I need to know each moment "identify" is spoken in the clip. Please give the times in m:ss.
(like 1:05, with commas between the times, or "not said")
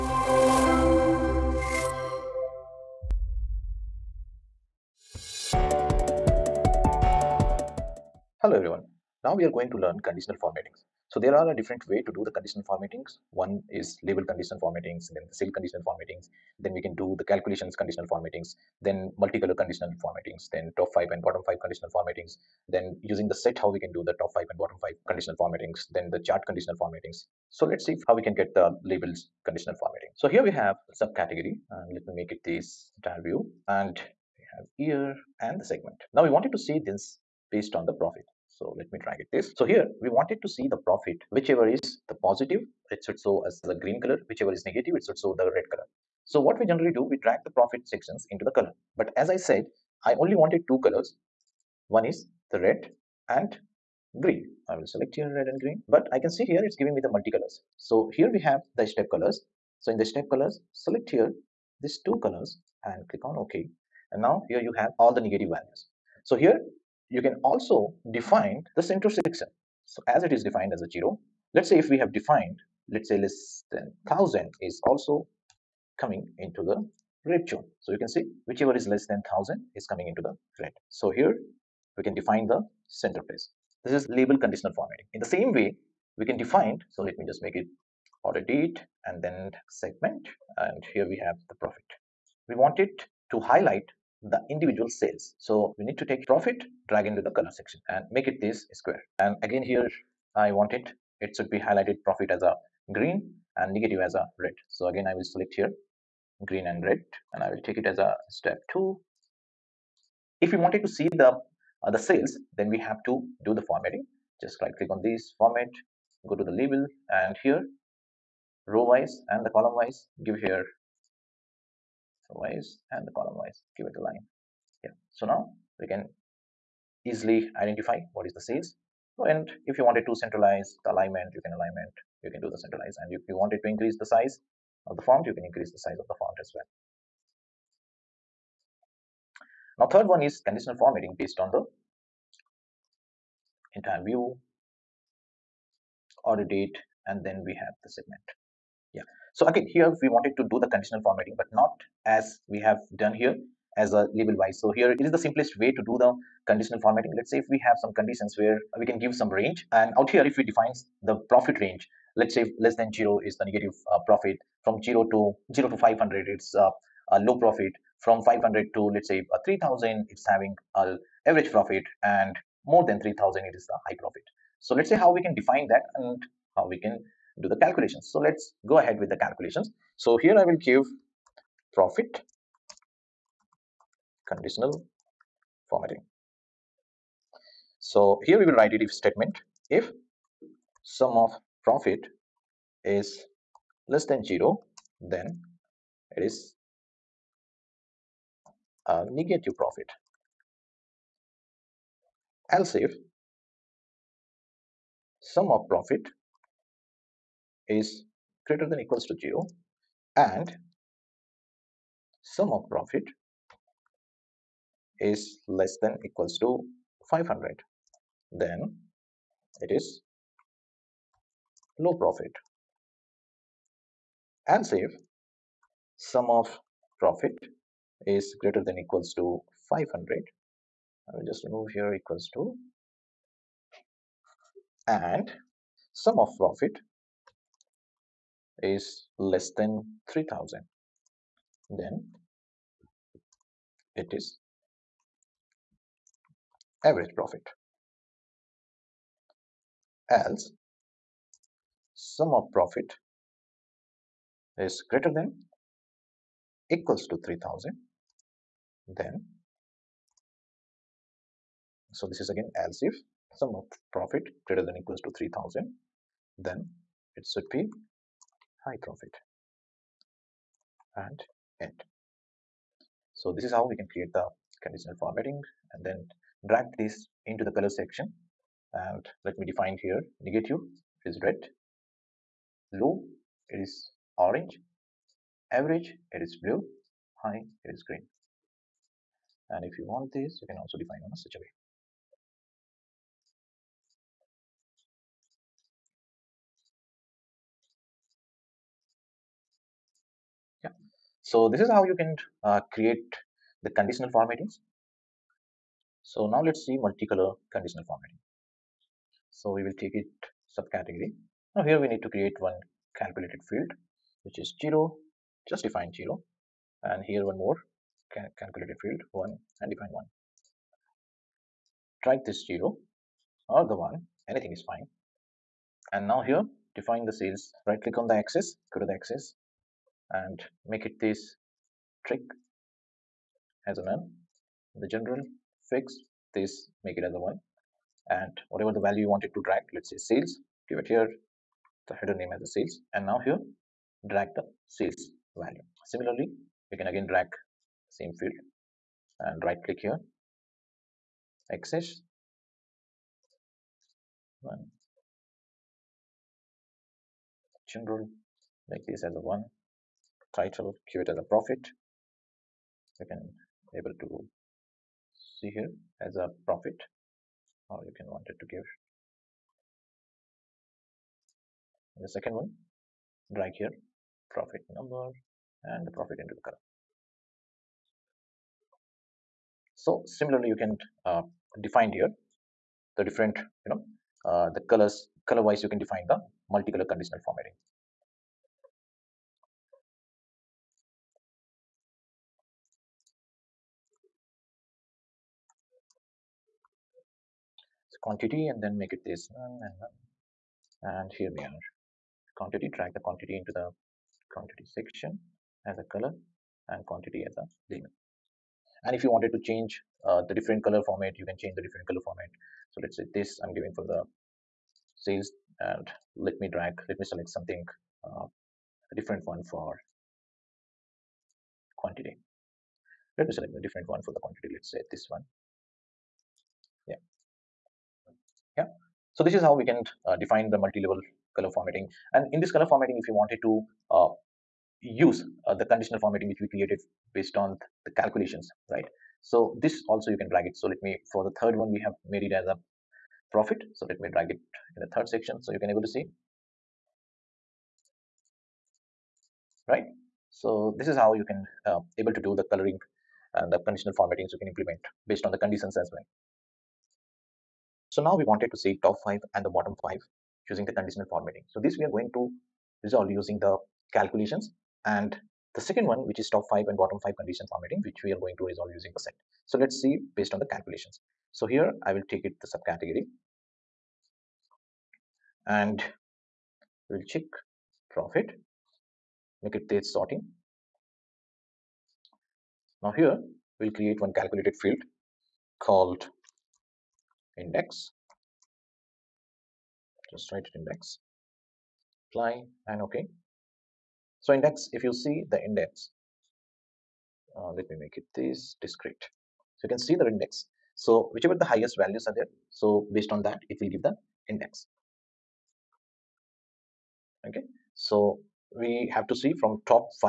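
2:07.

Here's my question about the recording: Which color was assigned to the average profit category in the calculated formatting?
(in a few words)
Blue.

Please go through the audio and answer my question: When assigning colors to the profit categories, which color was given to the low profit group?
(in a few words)
Orange.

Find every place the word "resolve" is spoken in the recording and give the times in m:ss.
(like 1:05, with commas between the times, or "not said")
7:42, 7:48.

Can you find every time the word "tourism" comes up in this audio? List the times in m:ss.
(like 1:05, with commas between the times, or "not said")
not said.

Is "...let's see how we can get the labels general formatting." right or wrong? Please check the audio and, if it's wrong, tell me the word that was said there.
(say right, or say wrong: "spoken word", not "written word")
wrong: "conditional", not "general".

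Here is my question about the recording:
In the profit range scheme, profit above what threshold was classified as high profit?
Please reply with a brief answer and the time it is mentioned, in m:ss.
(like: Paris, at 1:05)
3000, at 2:52.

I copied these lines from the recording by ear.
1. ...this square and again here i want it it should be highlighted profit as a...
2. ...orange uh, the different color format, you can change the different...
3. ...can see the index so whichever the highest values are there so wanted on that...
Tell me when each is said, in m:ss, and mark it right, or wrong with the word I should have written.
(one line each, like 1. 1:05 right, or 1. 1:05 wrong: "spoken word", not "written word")
1. 1:38 right
2. 6:49 wrong: "change", not "orange"
3. 8:19 wrong: "based", not "wanted".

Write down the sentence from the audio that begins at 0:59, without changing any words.
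So in the step colors, select here these two colors and click on OK.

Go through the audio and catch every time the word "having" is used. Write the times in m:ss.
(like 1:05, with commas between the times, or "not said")
2:50.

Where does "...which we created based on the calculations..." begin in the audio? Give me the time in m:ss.
7:16.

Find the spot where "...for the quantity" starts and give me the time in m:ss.
7:04.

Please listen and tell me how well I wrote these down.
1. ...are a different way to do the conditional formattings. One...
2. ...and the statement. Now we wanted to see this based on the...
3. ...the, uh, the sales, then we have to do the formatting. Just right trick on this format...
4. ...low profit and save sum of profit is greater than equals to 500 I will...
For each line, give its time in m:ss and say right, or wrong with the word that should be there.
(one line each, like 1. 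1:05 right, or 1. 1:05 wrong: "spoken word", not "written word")
1. 0:11 right
2. 0:35 wrong: "segment", not "statement"
3. 1:51 wrong: "click", not "trick"
4. 3:41 right.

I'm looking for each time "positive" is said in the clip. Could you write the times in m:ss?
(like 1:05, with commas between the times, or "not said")
0:42.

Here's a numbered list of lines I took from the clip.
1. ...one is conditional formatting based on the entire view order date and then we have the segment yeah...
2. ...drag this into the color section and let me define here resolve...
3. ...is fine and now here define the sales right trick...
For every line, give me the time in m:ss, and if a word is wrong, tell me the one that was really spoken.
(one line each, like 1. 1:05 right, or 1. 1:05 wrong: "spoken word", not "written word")
1. 2:20 right
2. 4:36 wrong: "negative", not "resolve"
3. 5:24 wrong: "click", not "trick".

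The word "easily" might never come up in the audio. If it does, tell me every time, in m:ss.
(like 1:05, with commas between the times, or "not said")
2:07.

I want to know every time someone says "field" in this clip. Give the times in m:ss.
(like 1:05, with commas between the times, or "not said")
5:13, 5:18, 5:48, 8:04.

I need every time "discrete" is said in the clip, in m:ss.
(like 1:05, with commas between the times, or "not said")
8:18.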